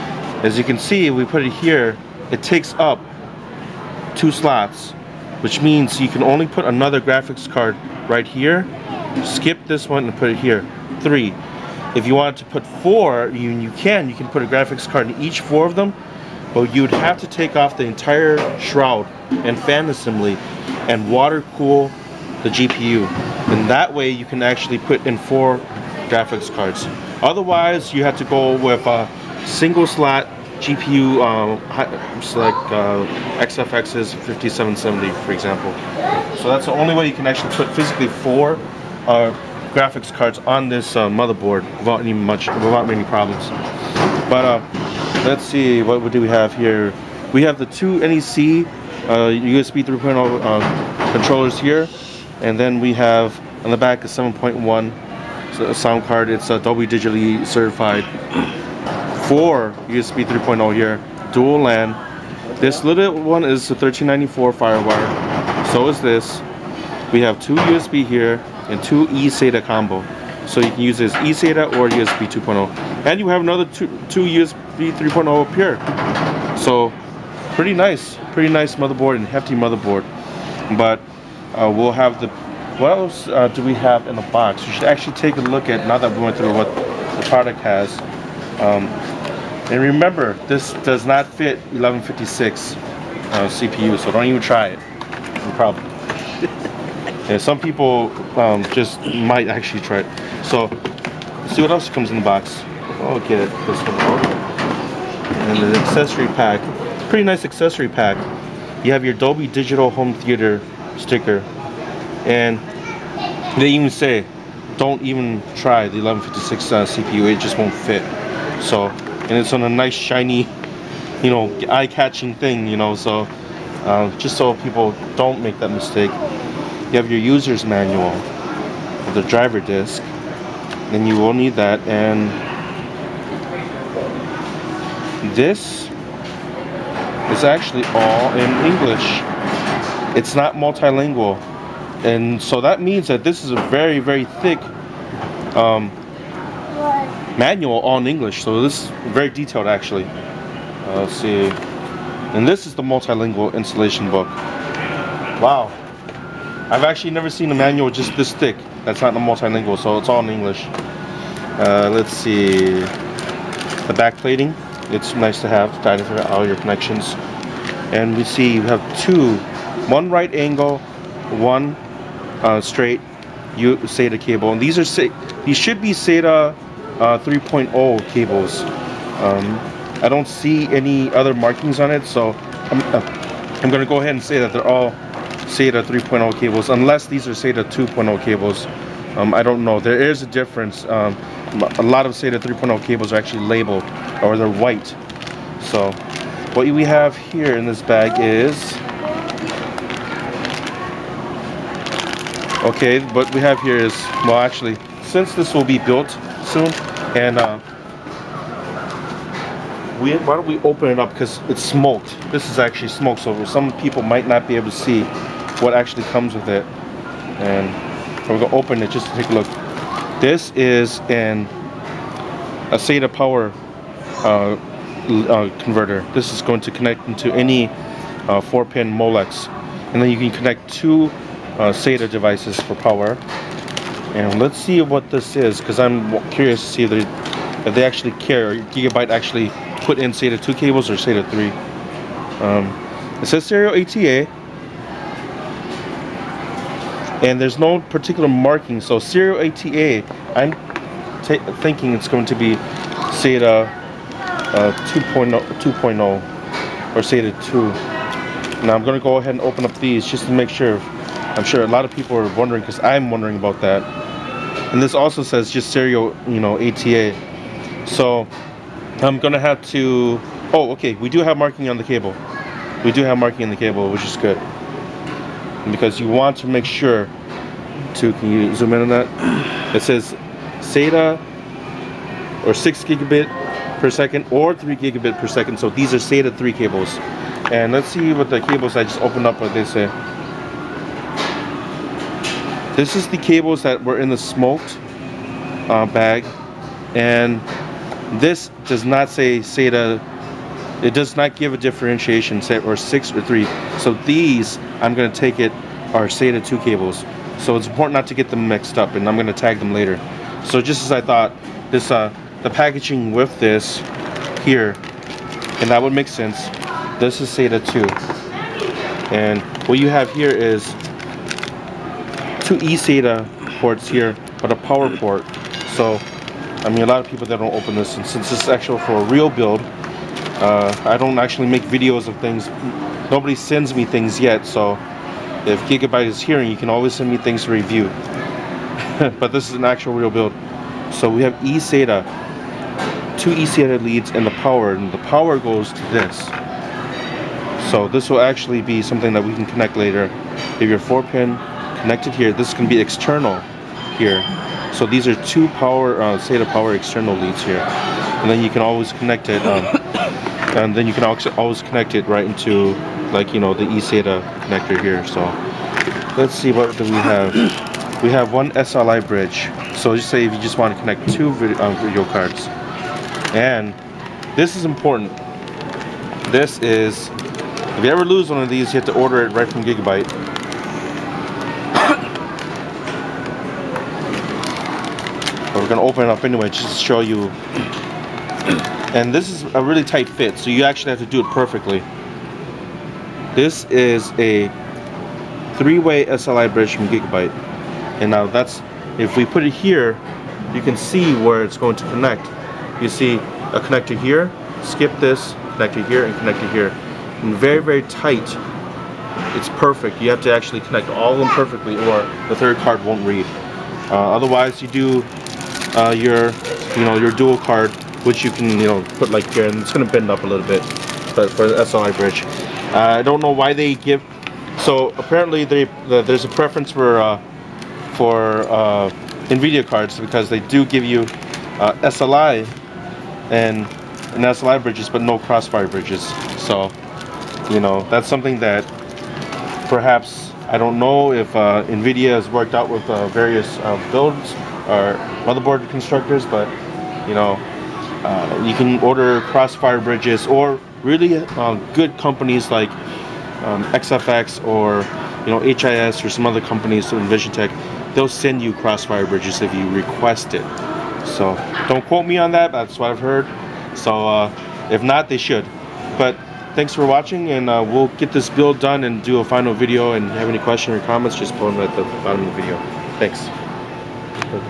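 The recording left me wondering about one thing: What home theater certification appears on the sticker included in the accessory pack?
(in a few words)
Dolby Digital Home Theater.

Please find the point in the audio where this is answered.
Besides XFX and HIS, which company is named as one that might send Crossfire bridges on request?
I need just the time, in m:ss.
7:36.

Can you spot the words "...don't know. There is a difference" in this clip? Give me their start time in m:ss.
3:09.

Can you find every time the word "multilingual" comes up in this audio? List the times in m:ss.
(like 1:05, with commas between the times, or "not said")
2:20, 2:32, 2:39.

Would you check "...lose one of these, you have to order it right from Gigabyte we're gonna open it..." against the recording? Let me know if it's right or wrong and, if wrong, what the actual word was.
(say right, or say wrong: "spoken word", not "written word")
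right.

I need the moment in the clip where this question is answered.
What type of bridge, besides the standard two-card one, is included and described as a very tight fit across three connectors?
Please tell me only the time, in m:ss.
6:35.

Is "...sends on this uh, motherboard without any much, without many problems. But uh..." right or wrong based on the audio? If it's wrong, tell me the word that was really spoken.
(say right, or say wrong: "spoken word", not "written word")
wrong: "cards", not "sends".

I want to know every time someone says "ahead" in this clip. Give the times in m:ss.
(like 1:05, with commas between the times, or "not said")
3:04, 4:19.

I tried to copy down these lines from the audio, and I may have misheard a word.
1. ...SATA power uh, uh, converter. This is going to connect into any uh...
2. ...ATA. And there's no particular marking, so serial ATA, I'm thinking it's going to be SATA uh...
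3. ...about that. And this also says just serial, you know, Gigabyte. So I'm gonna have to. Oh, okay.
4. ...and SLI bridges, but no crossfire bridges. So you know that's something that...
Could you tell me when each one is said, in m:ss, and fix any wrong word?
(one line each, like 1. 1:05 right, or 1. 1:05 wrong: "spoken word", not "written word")
1. 3:42 right
2. 4:03 right
3. 4:23 wrong: "ATA", not "Gigabyte"
4. 7:14 right.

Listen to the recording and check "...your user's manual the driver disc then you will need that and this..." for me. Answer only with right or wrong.
right.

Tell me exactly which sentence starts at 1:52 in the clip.
And they even say, don't even try the 1156 uh, CPU, it just won't fit.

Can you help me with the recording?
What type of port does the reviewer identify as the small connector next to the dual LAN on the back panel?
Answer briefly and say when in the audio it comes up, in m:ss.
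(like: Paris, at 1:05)
1394 FireWire, at 1:03.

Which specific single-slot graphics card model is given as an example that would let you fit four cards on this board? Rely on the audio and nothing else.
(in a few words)
XFX 5770.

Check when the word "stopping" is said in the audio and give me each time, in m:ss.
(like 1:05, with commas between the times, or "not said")
not said.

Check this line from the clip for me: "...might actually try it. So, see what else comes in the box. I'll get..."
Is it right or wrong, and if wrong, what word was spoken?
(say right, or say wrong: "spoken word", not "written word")
right.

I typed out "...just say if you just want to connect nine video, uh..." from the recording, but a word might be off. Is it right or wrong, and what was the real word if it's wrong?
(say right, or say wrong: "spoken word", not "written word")
wrong: "two", not "nine".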